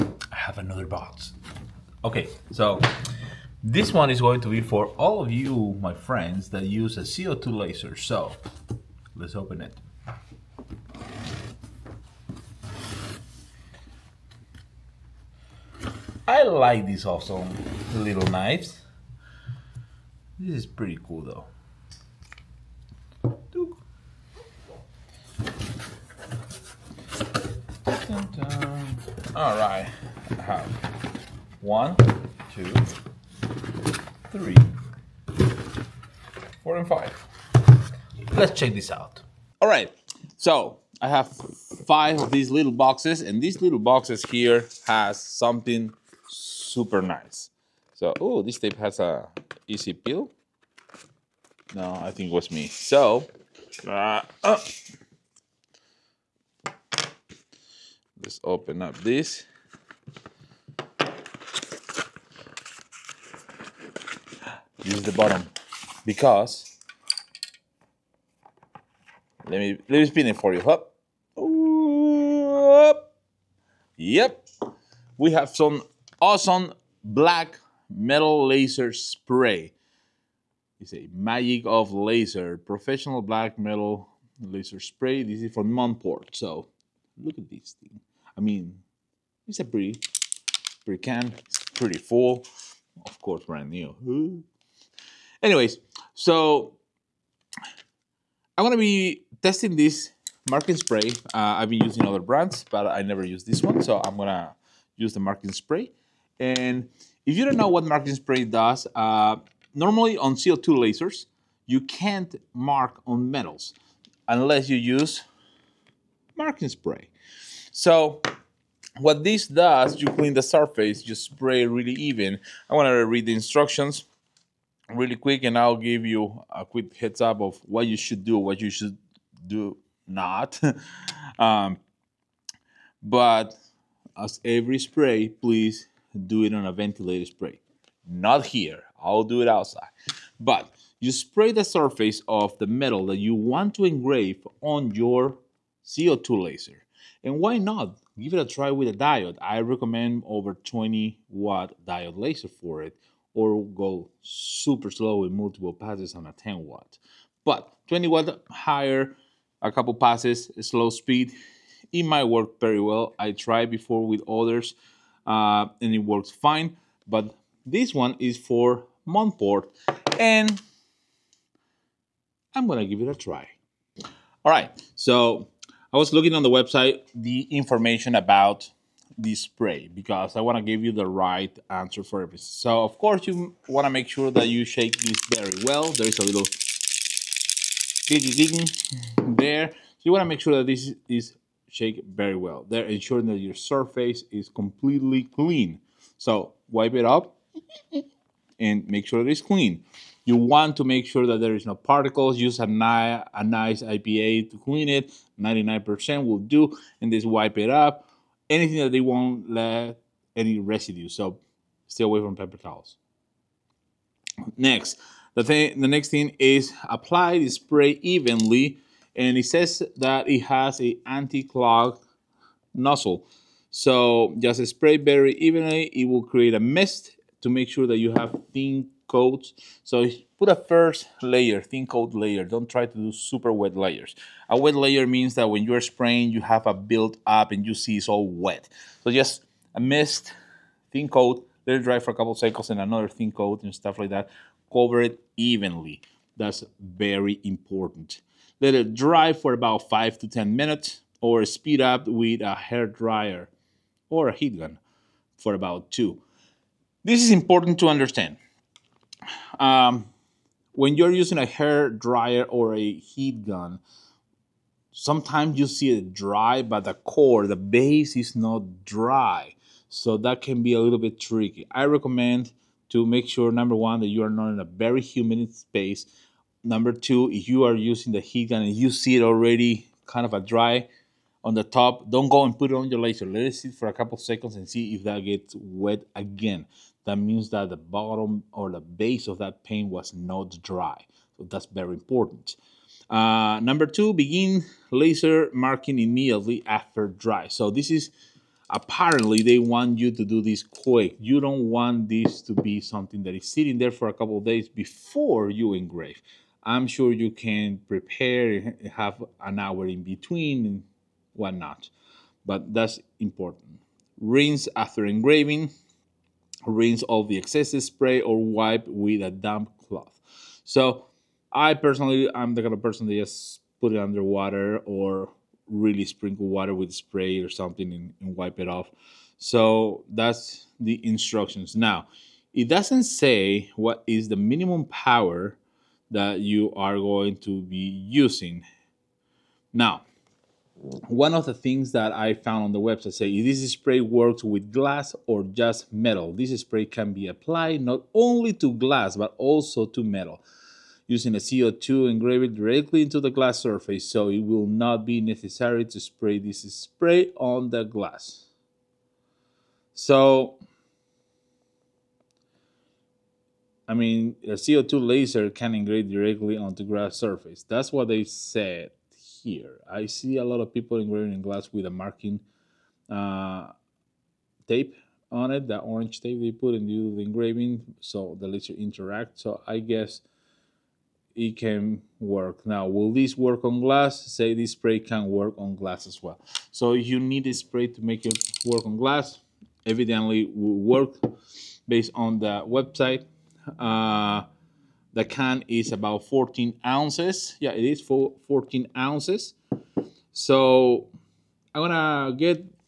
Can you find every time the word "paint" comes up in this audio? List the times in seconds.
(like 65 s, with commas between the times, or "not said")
289 s.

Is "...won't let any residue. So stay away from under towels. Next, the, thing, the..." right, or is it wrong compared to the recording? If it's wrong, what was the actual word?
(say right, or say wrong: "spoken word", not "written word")
wrong: "paper", not "under".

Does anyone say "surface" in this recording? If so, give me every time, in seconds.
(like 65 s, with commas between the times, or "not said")
120 s, 141 s, 193 s, 353 s, 367 s.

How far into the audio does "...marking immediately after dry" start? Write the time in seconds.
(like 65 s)
295 s.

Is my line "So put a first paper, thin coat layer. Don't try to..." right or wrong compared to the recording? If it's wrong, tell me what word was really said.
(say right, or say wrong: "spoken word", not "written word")
wrong: "layer", not "paper".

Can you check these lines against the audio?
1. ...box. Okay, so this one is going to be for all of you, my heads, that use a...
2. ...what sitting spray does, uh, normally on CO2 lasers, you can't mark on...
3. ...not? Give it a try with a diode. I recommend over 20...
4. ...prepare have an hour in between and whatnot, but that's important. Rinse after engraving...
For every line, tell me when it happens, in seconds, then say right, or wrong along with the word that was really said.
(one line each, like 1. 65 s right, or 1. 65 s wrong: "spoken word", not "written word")
1. 0 s wrong: "friends", not "heads"
2. 107 s wrong: "marking", not "sitting"
3. 147 s right
4. 307 s right.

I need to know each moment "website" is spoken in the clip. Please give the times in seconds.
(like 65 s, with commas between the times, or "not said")
176 s, 342 s, 392 s.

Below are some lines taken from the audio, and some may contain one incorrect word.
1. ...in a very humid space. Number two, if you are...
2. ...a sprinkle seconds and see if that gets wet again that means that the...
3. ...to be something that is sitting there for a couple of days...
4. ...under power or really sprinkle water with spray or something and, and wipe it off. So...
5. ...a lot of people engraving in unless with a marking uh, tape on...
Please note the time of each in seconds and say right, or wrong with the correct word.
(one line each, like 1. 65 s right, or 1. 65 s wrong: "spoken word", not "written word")
1. 274 s right
2. 283 s wrong: "couple", not "sprinkle"
3. 302 s right
4. 323 s wrong: "water", not "power"
5. 370 s wrong: "glass", not "unless".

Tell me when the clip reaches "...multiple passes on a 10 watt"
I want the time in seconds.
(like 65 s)
155 s.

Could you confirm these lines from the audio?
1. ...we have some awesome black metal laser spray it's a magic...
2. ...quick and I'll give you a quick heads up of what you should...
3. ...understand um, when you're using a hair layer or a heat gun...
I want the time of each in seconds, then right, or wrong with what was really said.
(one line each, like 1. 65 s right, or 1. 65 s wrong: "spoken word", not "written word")
1. 75 s right
2. 125 s right
3. 257 s wrong: "dryer", not "layer".